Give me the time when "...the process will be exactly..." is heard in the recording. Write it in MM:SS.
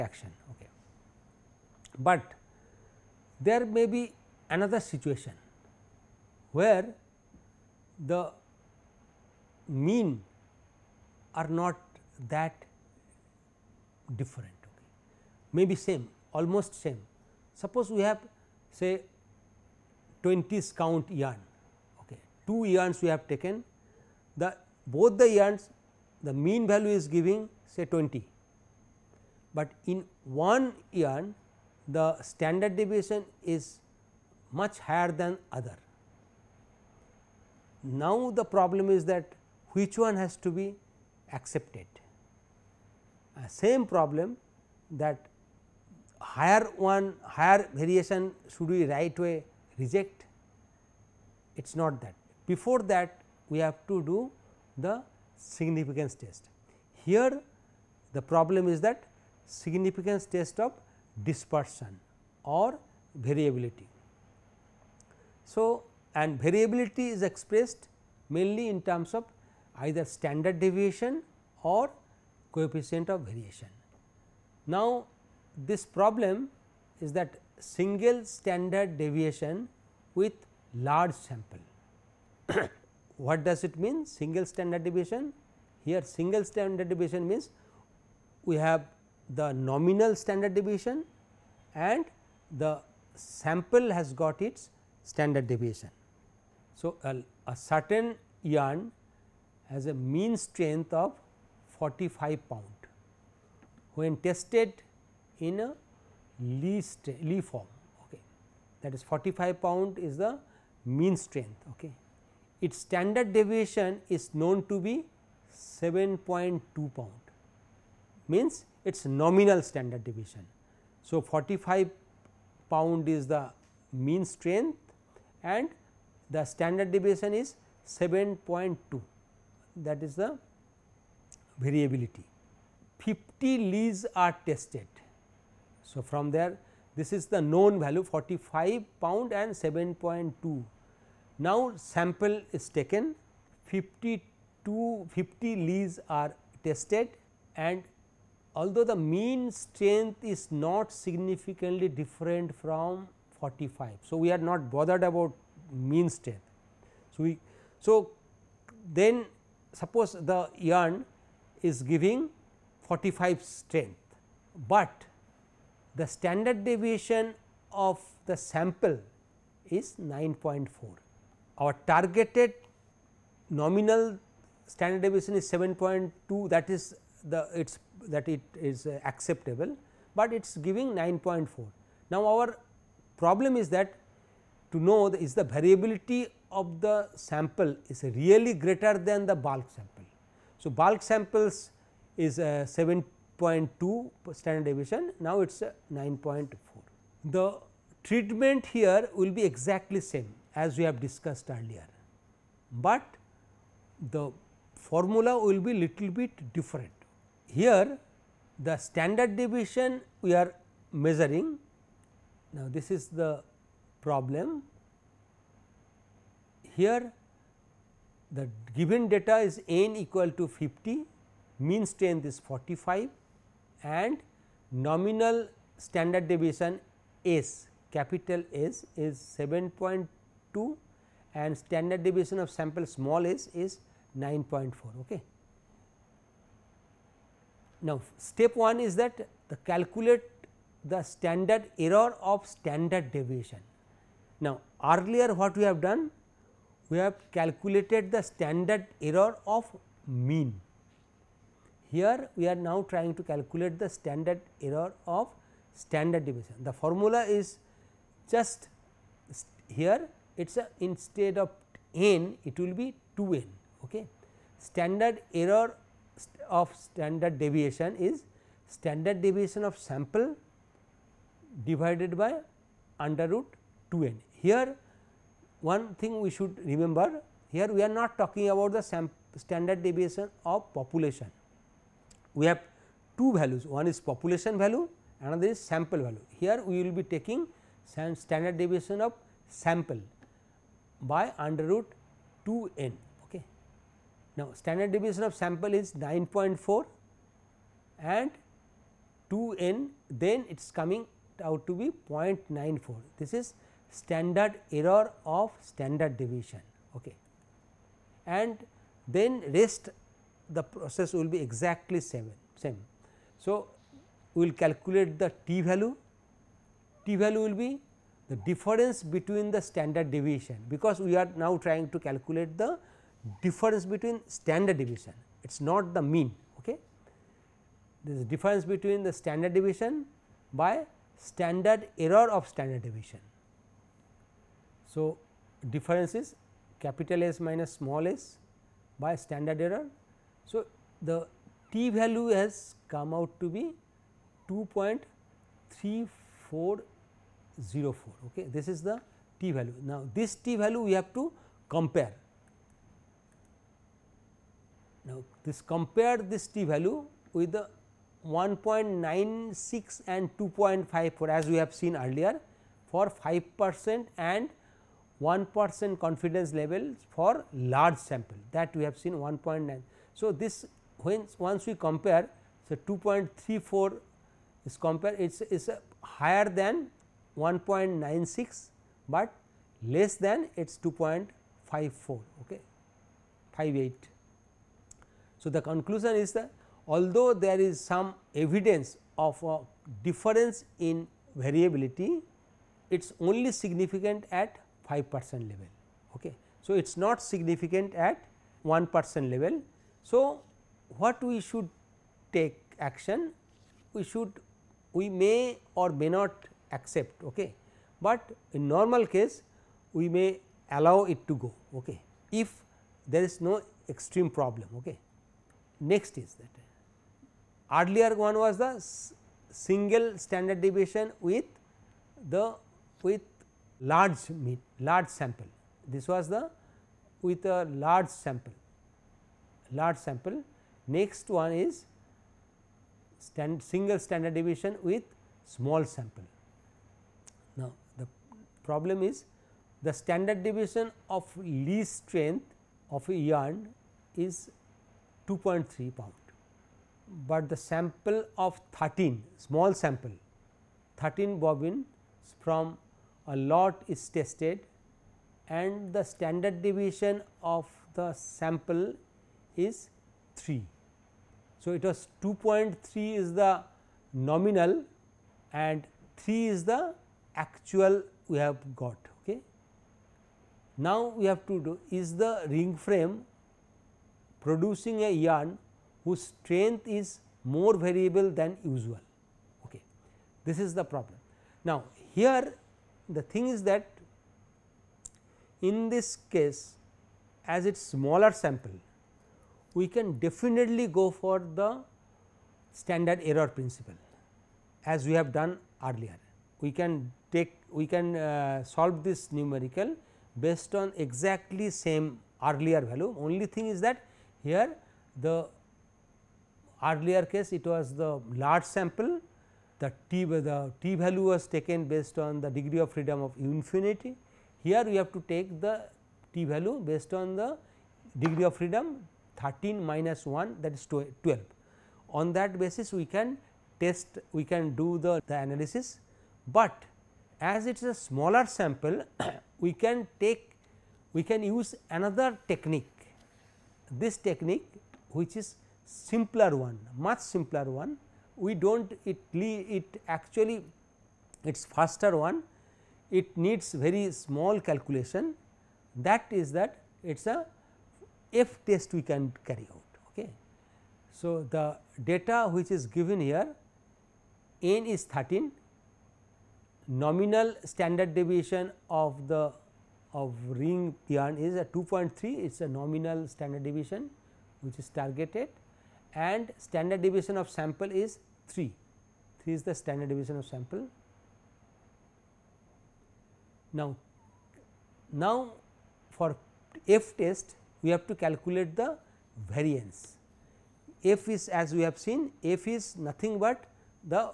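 05:10.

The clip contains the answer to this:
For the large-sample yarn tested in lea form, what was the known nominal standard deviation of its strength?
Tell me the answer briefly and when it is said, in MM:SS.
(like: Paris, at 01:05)
7.2 pound, at 01:55.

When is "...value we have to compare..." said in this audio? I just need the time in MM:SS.
05:50.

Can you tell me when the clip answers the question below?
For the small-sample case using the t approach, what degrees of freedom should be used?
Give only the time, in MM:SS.
08:40.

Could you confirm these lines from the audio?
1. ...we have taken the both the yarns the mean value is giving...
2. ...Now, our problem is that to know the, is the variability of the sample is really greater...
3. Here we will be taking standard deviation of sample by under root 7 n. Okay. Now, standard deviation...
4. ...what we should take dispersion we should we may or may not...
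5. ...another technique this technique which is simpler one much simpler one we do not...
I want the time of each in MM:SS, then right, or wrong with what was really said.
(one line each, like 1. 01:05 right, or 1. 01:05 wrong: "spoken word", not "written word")
1. 00:23 right
2. 03:02 right
3. 04:46 wrong: "2", not "7"
4. 06:41 wrong: "action", not "dispersion"
5. 08:51 right.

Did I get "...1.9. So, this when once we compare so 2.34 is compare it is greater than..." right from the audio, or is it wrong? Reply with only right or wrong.
wrong.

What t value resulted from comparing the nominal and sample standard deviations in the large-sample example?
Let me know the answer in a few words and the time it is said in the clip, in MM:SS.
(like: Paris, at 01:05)
2.3404, at 05:44.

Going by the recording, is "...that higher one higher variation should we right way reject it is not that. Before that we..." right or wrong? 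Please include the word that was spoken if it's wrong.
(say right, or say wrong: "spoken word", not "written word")
right.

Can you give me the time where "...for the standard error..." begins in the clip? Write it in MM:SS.
08:11.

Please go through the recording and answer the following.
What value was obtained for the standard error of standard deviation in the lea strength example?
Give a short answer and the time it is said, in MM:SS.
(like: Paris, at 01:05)
0.94, at 05:02.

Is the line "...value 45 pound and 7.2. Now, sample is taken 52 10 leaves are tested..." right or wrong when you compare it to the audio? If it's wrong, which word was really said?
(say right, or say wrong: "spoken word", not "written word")
wrong: "50", not "10".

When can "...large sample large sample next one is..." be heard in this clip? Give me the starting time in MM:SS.
07:07.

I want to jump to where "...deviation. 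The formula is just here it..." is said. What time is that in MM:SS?
04:16.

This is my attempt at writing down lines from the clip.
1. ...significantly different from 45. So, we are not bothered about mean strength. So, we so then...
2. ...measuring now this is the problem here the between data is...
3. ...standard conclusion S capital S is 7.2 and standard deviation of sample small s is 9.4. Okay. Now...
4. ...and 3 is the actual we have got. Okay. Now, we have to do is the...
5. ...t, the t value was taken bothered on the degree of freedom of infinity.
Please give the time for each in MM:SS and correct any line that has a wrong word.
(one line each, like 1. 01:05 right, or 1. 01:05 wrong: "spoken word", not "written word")
1. 02:30 right
2. 03:30 wrong: "given", not "between"
3. 03:45 wrong: "deviation", not "conclusion"
4. 07:45 right
5. 08:30 wrong: "based", not "bothered".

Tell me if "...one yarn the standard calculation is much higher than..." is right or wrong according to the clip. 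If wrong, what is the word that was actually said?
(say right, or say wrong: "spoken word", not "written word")
wrong: "deviation", not "calculation".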